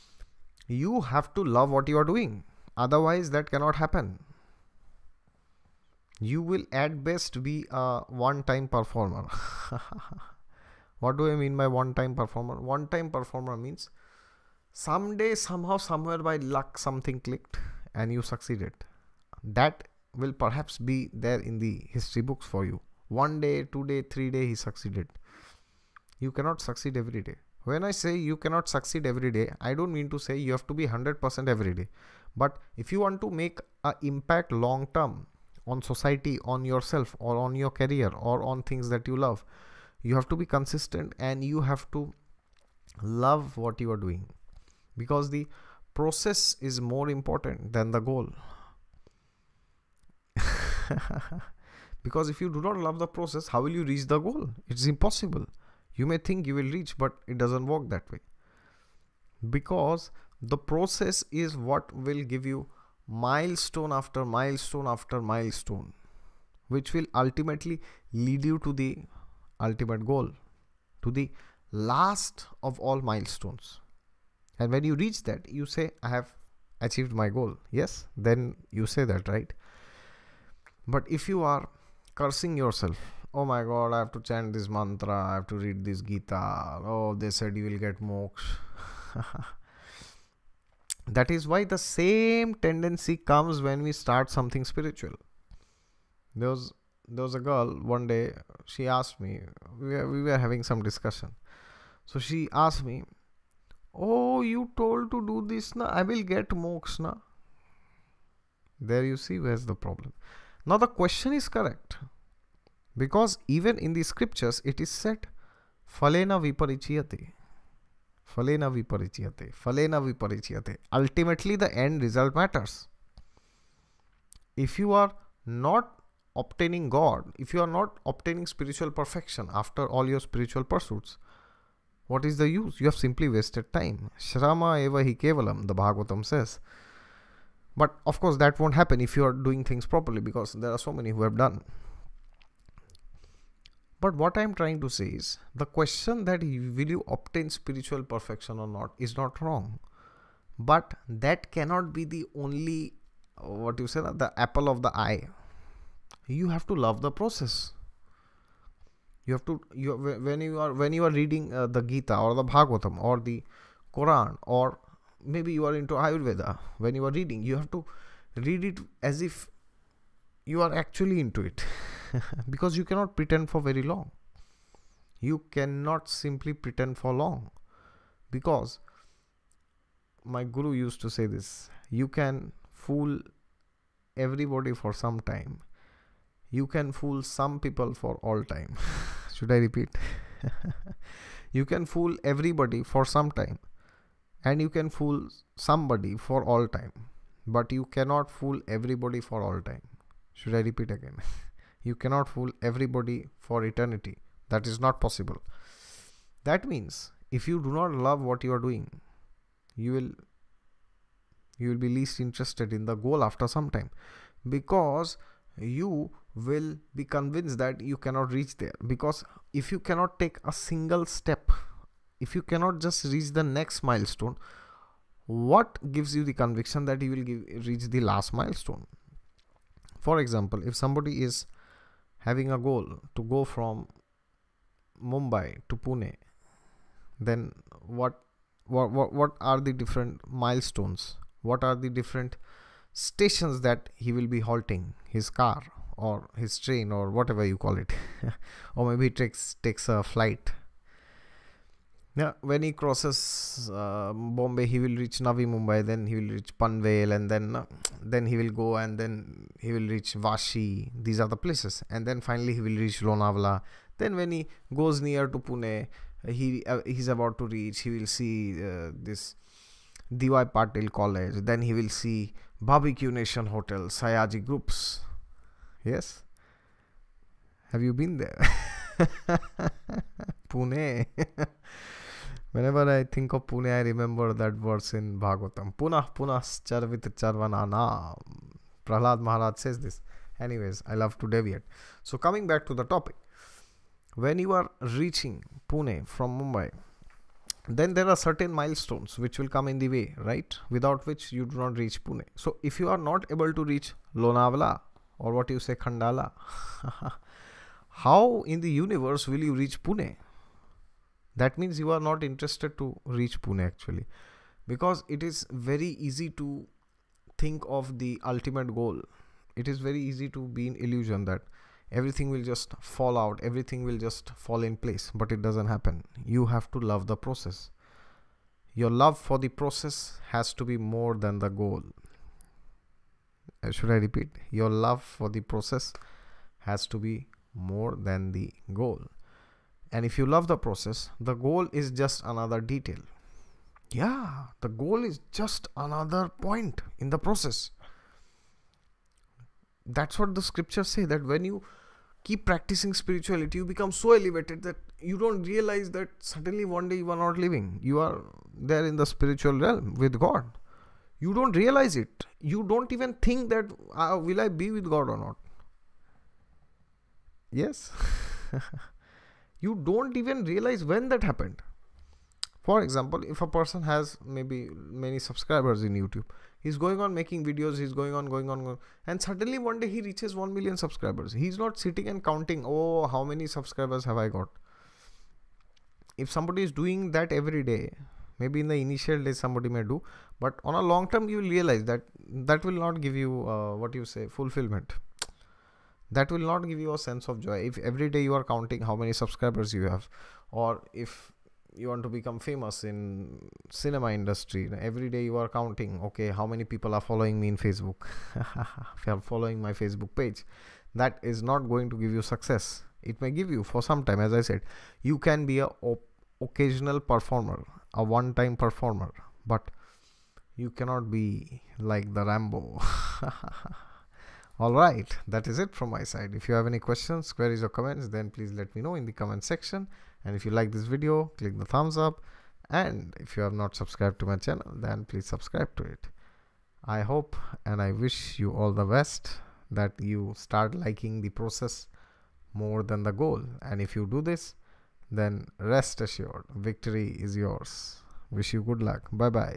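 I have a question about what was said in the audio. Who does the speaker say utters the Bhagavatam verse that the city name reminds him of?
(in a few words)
Prahlad Maharaj.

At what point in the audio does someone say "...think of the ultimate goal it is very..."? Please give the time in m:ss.
5:17.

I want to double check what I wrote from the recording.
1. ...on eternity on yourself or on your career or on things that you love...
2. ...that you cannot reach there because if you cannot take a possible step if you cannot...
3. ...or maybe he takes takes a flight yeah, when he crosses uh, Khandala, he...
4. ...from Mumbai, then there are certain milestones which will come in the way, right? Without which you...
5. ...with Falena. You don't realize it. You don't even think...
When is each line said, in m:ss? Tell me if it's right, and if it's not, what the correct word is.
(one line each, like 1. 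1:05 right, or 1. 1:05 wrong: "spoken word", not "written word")
1. 0:35 wrong: "society", not "eternity"
2. 3:37 wrong: "single", not "possible"
3. 4:08 wrong: "Bombay", not "Khandala"
4. 4:56 right
5. 5:59 wrong: "God", not "Falena".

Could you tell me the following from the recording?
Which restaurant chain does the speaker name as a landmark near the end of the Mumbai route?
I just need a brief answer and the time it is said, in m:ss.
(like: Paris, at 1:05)
Barbecue Nation, at 4:32.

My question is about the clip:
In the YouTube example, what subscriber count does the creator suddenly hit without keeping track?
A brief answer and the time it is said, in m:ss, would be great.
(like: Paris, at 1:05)
1 million, at 6:20.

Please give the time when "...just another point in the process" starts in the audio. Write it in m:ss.
5:45.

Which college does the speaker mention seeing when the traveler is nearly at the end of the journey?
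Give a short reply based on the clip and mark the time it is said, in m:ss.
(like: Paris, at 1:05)
D.Y. Patil College, at 4:30.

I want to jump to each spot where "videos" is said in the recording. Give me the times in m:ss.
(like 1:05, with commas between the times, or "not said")
6:17, 7:10.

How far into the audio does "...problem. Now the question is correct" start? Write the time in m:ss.
1:49.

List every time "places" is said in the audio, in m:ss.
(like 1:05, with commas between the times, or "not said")
4:21, 5:24.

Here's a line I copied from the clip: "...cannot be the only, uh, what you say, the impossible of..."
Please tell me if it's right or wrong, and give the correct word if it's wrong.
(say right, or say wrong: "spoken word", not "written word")
wrong: "apple", not "impossible".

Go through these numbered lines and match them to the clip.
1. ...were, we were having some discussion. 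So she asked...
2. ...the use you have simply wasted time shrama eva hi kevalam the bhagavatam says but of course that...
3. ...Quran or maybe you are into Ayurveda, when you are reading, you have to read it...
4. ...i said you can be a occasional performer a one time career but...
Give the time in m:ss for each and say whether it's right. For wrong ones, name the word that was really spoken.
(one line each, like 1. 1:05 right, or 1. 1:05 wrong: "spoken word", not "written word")
1. 1:39 right
2. 2:12 right
3. 2:43 right
4. 6:54 wrong: "performer", not "career".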